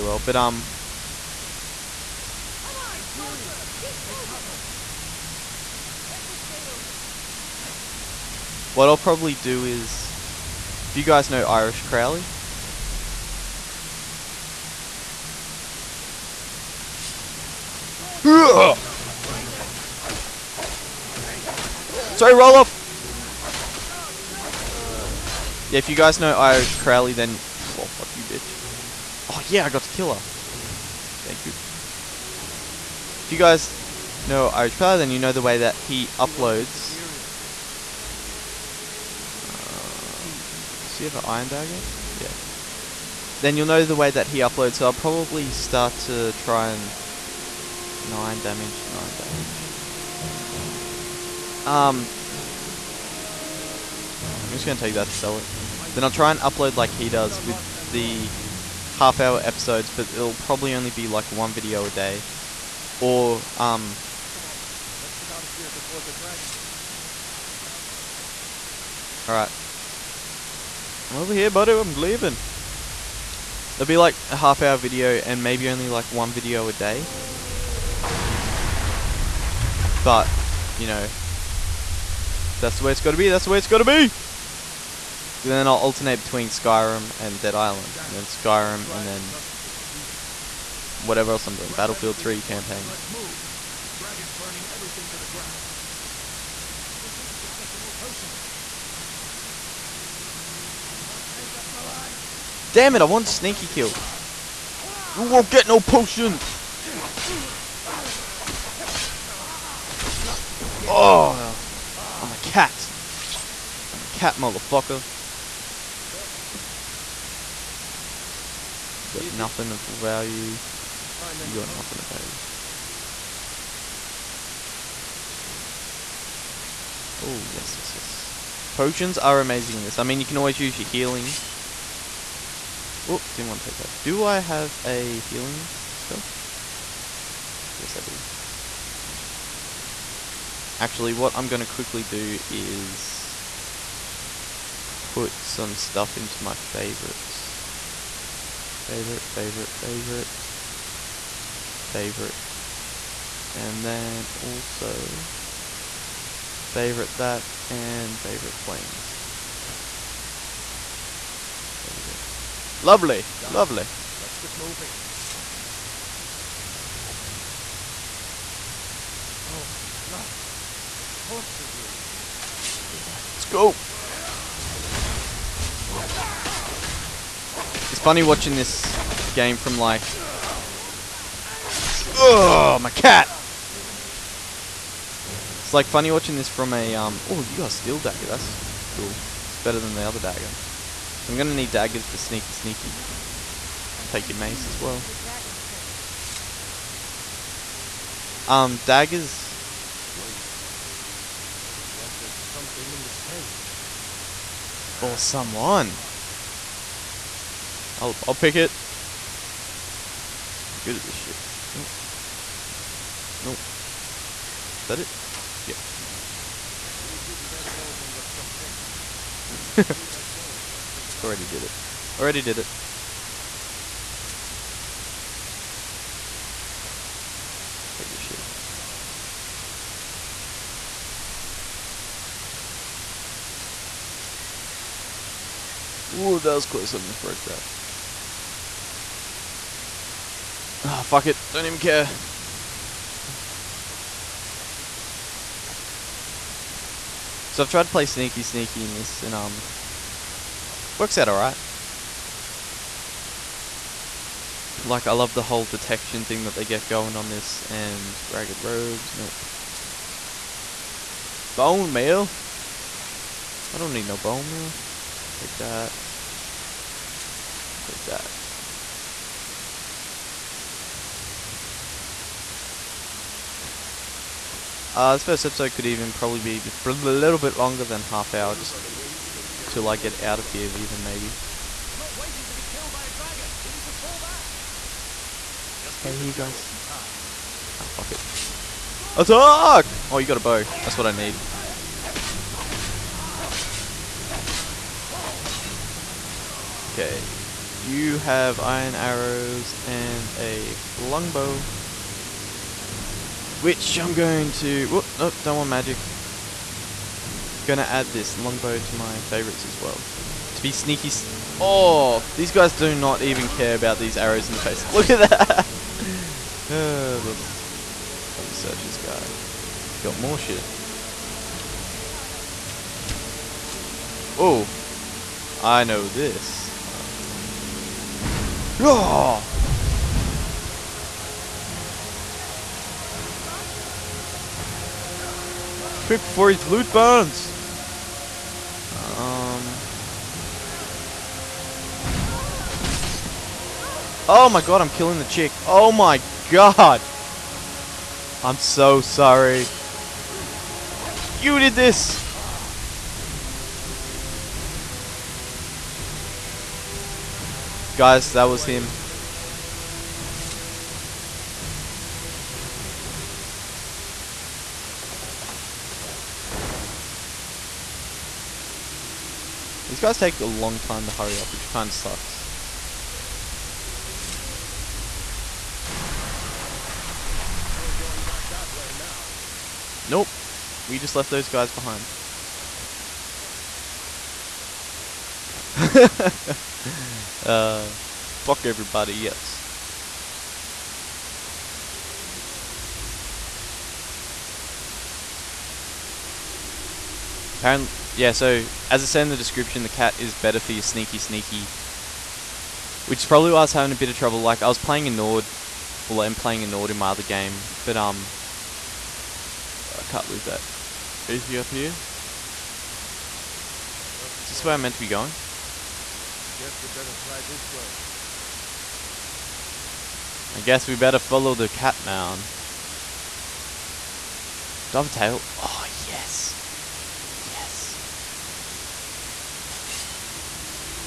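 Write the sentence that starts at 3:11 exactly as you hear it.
So I'm going to need daggers for sneaky sneaky.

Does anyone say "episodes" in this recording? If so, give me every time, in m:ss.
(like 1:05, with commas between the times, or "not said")
0:59, 4:35.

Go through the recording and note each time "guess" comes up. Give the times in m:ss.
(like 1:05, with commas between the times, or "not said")
6:56, 7:00.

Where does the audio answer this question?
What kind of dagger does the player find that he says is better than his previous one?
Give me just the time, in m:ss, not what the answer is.
3:07.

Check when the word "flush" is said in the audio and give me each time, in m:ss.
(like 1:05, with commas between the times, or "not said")
not said.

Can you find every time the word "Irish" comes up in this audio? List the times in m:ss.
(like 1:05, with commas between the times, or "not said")
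0:11, 0:26, 0:34.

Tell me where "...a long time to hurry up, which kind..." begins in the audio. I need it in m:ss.
6:10.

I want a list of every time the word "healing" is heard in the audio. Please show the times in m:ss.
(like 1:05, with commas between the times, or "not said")
2:10, 2:15.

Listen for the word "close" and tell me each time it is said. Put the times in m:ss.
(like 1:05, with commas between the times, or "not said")
3:56.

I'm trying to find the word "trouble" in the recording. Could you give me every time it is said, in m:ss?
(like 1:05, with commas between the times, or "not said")
6:44.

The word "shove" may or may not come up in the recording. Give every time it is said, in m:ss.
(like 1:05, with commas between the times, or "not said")
not said.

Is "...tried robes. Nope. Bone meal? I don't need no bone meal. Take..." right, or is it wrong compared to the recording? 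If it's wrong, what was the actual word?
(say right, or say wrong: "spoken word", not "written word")
wrong: "ragged", not "tried".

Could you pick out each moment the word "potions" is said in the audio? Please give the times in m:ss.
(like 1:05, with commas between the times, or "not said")
1:37, 1:45, 2:08.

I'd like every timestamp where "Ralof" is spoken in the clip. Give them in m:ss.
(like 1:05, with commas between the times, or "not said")
0:22.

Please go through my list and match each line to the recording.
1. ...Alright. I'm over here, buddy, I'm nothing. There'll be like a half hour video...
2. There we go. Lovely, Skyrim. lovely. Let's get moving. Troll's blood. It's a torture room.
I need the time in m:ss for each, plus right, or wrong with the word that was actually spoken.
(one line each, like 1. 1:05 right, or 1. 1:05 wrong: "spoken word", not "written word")
1. 1:09 wrong: "leaving", not "nothing"
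2. 2:41 wrong: "Done", not "Skyrim".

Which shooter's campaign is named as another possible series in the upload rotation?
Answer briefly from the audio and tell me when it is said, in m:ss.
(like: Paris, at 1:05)
Battlefield 3, at 1:31.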